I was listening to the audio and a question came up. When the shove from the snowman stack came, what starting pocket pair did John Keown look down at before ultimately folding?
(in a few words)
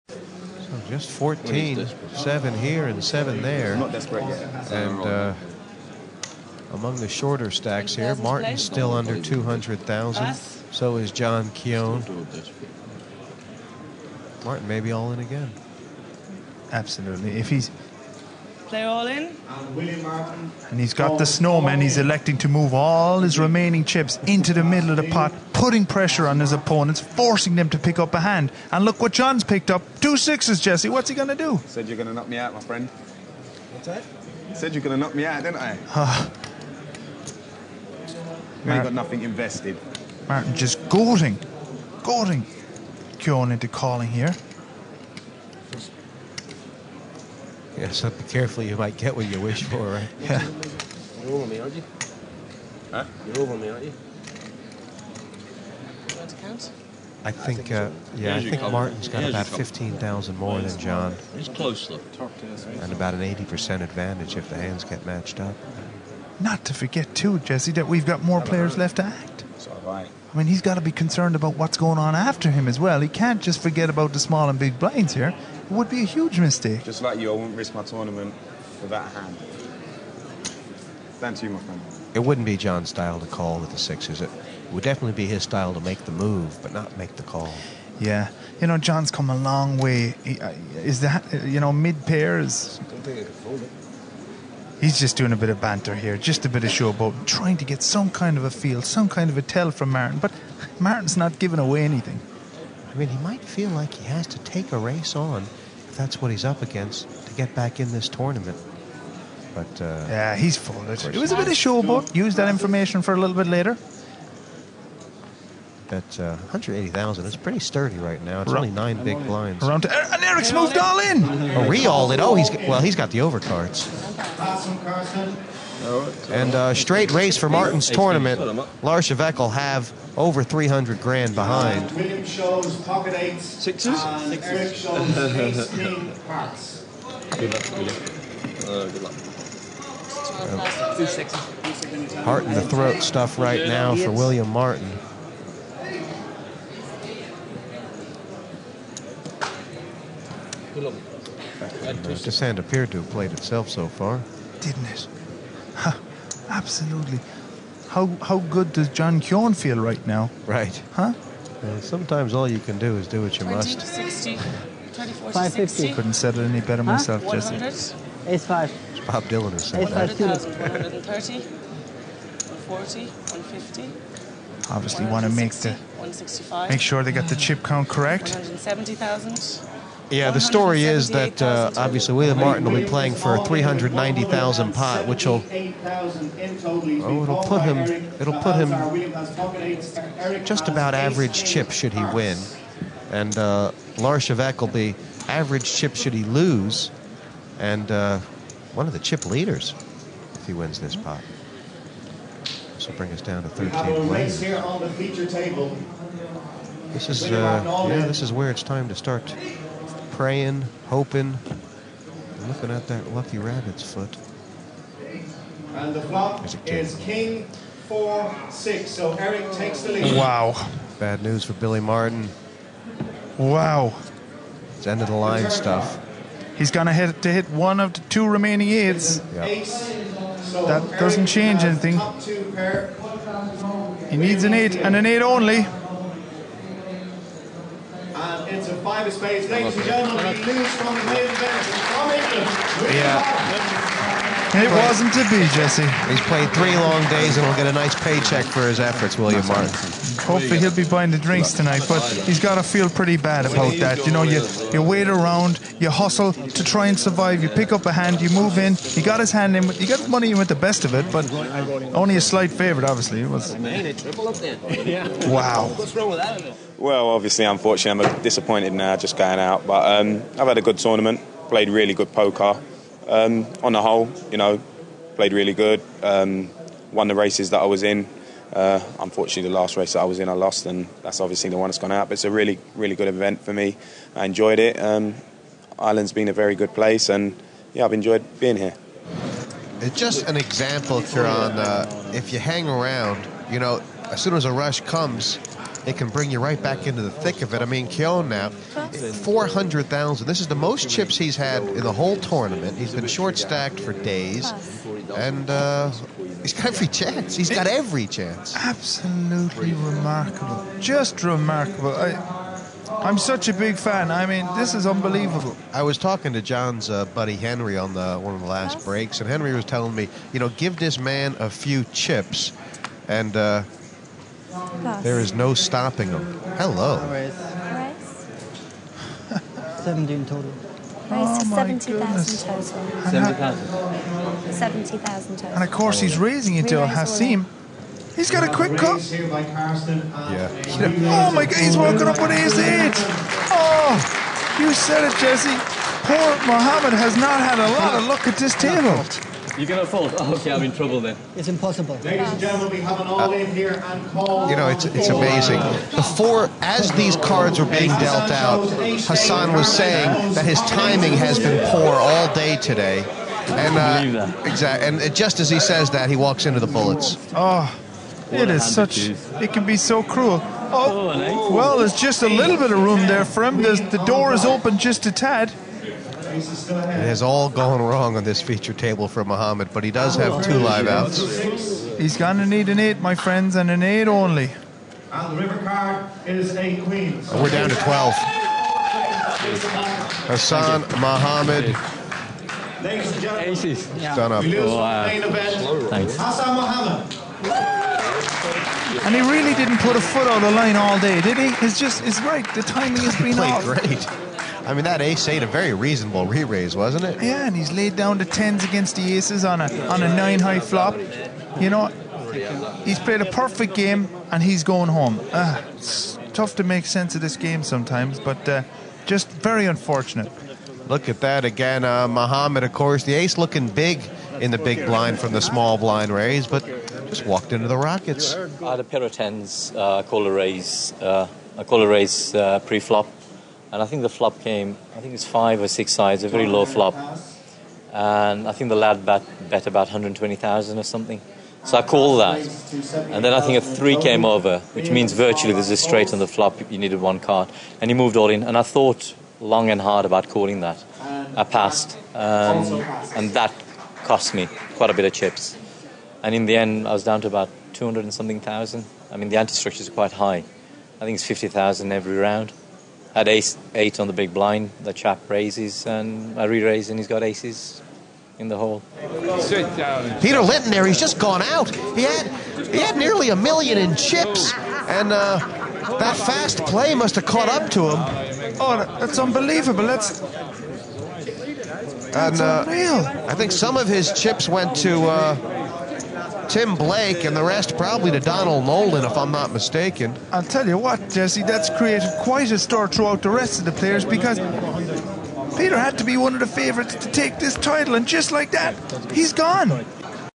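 Two sixes.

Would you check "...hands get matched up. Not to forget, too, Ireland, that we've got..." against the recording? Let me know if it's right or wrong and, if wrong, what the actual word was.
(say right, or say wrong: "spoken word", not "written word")
wrong: "Jesse", not "Ireland".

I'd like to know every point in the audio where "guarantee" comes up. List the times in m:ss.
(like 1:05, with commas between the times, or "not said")
not said.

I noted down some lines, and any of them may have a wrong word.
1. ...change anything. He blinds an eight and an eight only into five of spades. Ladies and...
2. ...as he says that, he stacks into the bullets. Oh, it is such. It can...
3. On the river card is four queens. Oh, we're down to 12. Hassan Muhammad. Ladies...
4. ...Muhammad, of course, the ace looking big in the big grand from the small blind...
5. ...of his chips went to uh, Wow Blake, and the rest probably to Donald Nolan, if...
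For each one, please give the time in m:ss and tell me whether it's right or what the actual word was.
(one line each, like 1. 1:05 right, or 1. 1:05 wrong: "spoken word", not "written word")
1. 3:51 wrong: "needs", not "blinds"
2. 6:05 wrong: "walks", not "stacks"
3. 6:25 wrong: "eight", not "four"
4. 7:02 wrong: "blind", not "grand"
5. 8:03 wrong: "Tim", not "Wow".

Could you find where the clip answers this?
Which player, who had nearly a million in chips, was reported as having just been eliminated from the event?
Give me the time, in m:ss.
7:50.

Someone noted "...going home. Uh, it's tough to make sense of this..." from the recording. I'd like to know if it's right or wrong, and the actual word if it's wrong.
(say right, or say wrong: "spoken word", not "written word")
right.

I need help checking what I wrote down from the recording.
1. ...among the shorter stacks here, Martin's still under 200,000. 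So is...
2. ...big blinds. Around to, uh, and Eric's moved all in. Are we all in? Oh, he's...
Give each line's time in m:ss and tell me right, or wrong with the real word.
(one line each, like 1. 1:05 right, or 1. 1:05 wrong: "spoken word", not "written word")
1. 0:06 right
2. 1:59 right.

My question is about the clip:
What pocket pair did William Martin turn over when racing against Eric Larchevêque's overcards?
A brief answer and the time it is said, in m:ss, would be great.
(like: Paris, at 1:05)
Pocket eights, at 2:12.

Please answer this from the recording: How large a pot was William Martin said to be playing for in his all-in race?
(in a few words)
390,000.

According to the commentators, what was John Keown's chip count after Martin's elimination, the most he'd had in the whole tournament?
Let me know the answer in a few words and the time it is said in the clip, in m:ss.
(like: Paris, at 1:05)
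400,000, at 4:58.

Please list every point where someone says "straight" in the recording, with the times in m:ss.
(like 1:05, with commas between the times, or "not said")
2:06, 7:25.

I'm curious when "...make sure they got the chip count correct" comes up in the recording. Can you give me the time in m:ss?
2:56.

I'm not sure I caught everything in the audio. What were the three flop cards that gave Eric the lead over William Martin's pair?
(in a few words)
King four six.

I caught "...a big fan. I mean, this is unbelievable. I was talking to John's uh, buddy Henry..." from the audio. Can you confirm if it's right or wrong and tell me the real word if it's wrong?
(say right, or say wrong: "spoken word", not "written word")
right.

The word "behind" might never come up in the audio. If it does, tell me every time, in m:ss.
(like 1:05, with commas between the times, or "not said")
2:11.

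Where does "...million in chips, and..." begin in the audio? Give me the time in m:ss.
7:53.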